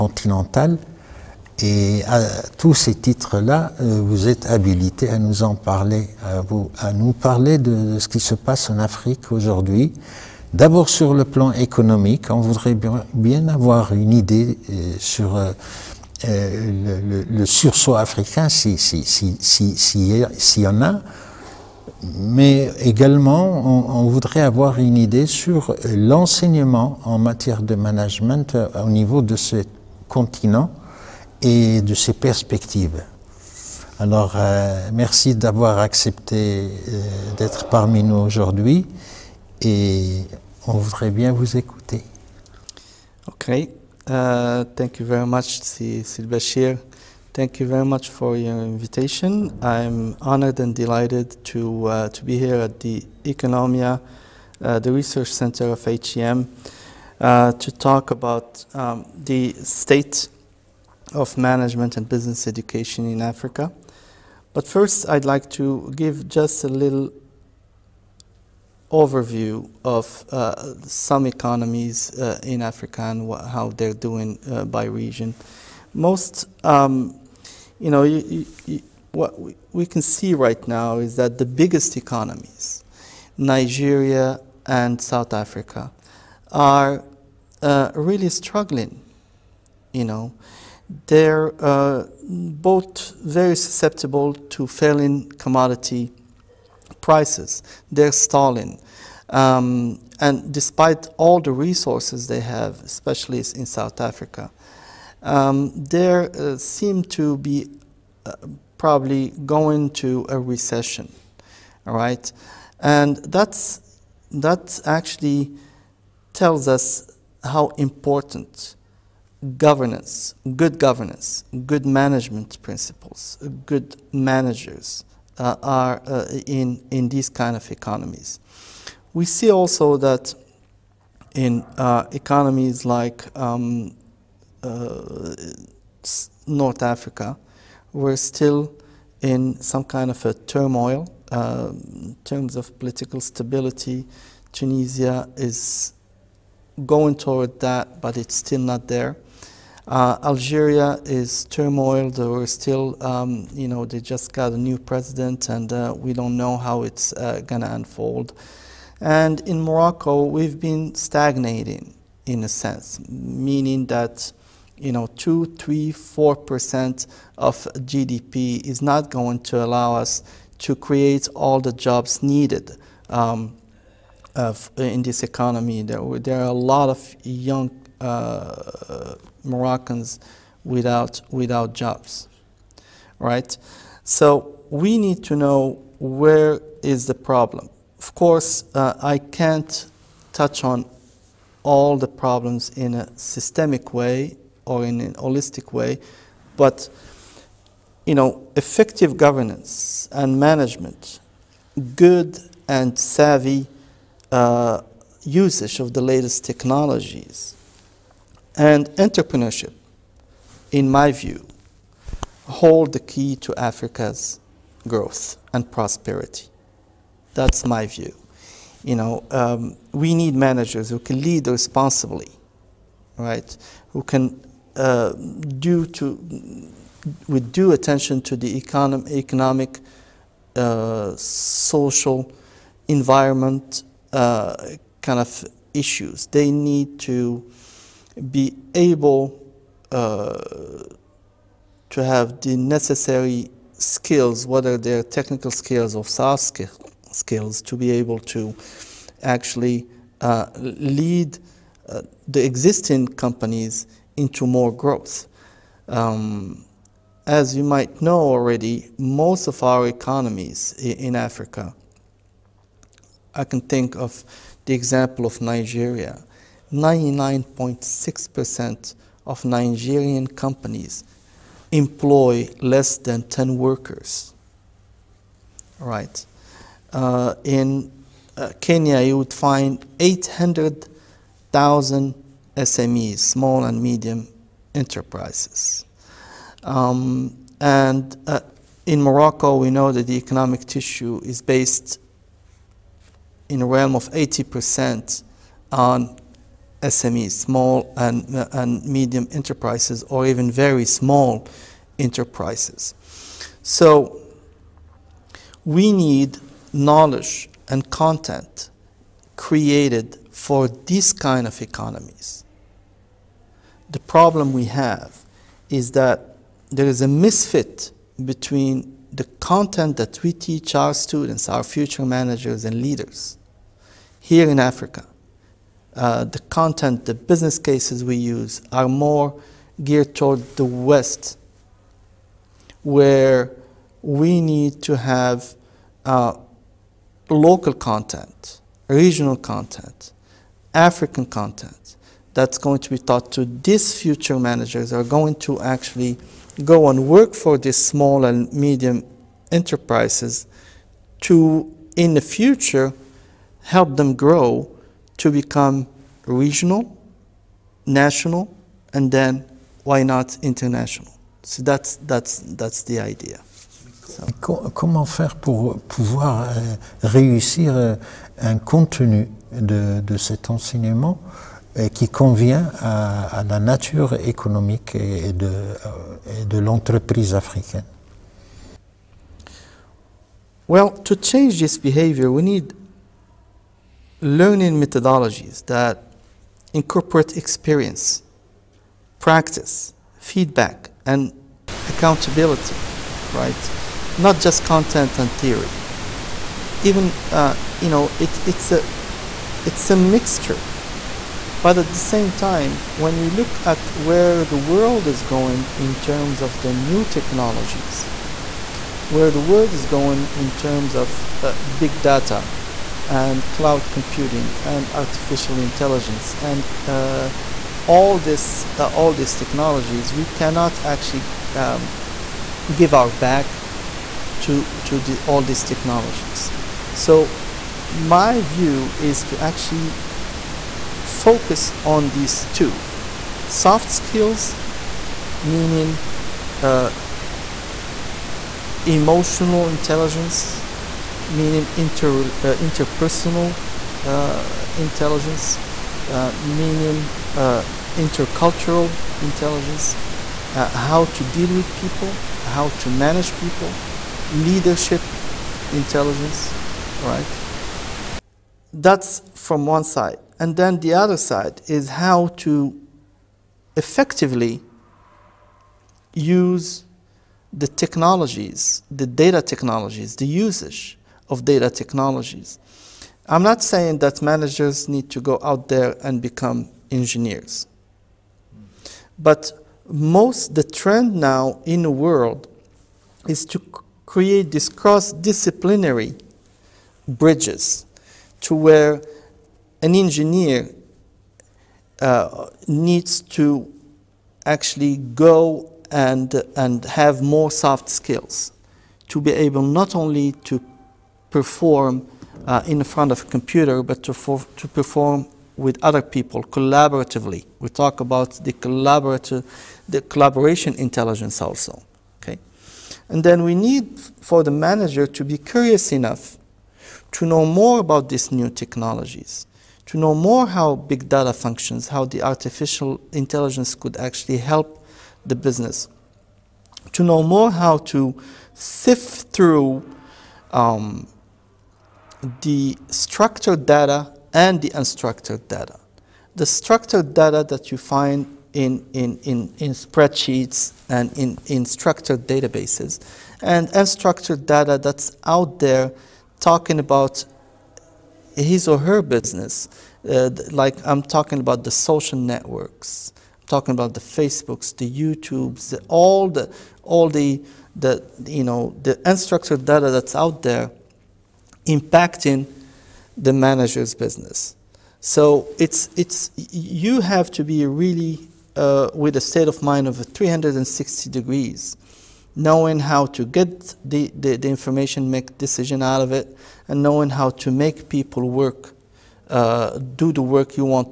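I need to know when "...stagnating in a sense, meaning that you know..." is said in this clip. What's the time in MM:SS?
02:40.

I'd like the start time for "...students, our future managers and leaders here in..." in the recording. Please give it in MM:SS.
05:20.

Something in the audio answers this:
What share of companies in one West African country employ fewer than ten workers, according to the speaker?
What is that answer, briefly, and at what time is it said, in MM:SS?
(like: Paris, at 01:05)
99.6%, at 04:26.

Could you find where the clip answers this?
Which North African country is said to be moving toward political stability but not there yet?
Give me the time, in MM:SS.
02:24.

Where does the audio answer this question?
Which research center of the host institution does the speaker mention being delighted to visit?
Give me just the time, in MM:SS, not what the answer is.
00:53.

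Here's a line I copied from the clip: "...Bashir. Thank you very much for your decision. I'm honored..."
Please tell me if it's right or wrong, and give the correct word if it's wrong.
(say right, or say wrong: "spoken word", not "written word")
wrong: "invitation", not "decision".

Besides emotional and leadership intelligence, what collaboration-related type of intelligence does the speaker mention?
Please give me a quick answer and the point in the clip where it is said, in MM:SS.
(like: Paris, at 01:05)
Collaboration intelligence, at 08:29.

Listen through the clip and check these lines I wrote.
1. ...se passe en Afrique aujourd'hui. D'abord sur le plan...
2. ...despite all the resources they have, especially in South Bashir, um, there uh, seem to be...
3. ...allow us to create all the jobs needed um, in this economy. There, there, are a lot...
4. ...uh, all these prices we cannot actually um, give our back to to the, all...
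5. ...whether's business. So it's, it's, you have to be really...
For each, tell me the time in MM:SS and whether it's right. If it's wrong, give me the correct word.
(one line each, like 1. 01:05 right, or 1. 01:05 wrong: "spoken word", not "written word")
1. 00:08 right
2. 01:40 wrong: "Africa", not "Bashir"
3. 02:49 right
4. 06:58 wrong: "technologies", not "prices"
5. 09:23 wrong: "manager", not "whether".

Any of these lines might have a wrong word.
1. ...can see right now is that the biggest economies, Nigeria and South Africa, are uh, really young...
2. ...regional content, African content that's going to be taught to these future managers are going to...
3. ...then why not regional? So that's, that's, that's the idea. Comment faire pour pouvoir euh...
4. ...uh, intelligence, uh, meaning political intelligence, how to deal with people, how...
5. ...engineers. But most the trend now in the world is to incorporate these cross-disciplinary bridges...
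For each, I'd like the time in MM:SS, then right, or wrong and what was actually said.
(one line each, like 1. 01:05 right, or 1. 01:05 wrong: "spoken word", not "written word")
1. 01:19 wrong: "struggling", not "young"
2. 05:38 right
3. 05:59 wrong: "international", not "regional"
4. 07:24 wrong: "intercultural", not "political"
5. 07:56 wrong: "create", not "incorporate".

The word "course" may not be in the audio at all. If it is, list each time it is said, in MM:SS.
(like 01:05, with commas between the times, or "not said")
03:08.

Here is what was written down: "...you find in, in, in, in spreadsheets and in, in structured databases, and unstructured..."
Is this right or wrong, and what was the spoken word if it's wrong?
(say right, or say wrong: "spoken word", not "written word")
right.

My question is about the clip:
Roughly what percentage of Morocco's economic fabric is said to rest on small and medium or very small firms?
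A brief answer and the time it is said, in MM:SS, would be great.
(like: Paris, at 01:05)
80%, at 04:54.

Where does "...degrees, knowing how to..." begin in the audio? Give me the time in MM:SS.
09:31.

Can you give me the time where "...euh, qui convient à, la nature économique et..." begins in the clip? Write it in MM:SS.
06:11.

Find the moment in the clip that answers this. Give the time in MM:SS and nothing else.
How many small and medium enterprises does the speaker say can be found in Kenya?
04:39.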